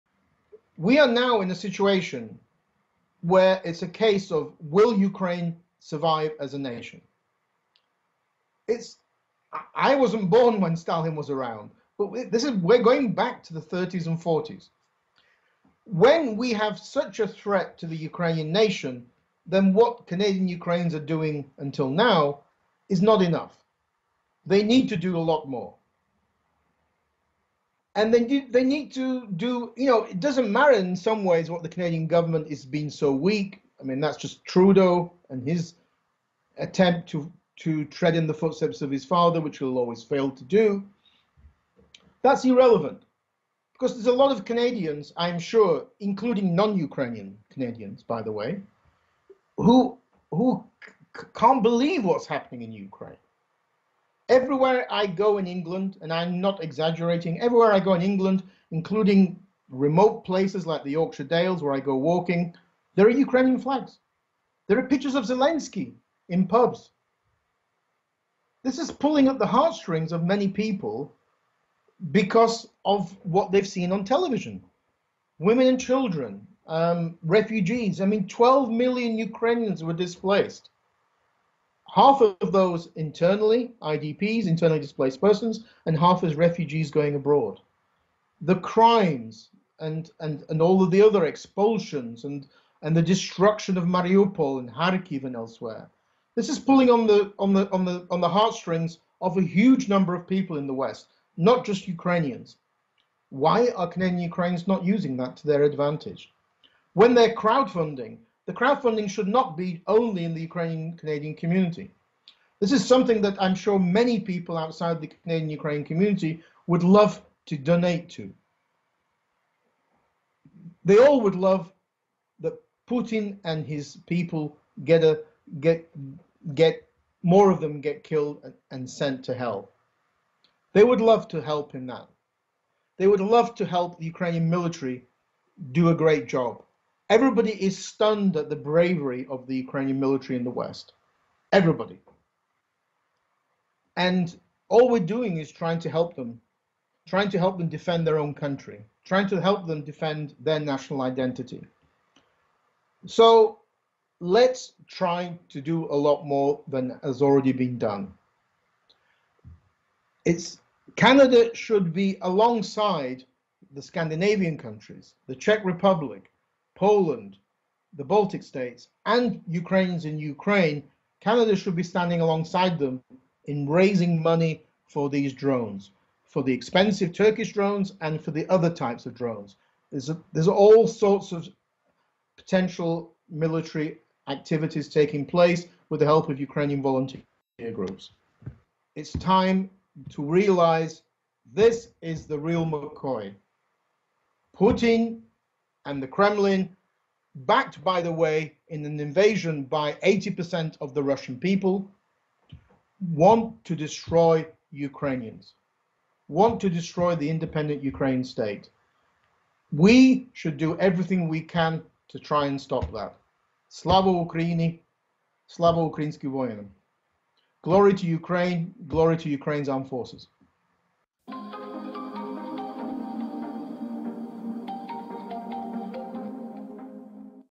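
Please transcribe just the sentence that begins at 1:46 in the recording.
When they're crowdfunding, the crowdfunding should not be only in the Ukrainian Canadian community.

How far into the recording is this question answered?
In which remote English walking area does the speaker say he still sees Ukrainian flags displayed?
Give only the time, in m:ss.
1:00.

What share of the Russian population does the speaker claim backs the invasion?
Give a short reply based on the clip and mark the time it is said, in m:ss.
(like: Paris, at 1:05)
80%, at 3:20.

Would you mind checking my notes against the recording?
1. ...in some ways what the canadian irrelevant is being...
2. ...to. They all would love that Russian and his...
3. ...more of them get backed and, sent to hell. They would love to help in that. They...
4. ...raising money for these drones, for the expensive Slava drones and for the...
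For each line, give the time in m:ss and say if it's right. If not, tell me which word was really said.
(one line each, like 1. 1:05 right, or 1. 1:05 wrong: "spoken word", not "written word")
1. 0:30 wrong: "government", not "irrelevant"
2. 1:58 wrong: "Putin", not "Russian"
3. 2:07 wrong: "killed", not "backed"
4. 2:53 wrong: "Turkish", not "Slava".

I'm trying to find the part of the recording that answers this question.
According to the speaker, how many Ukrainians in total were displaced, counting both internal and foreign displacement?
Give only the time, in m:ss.
1:18.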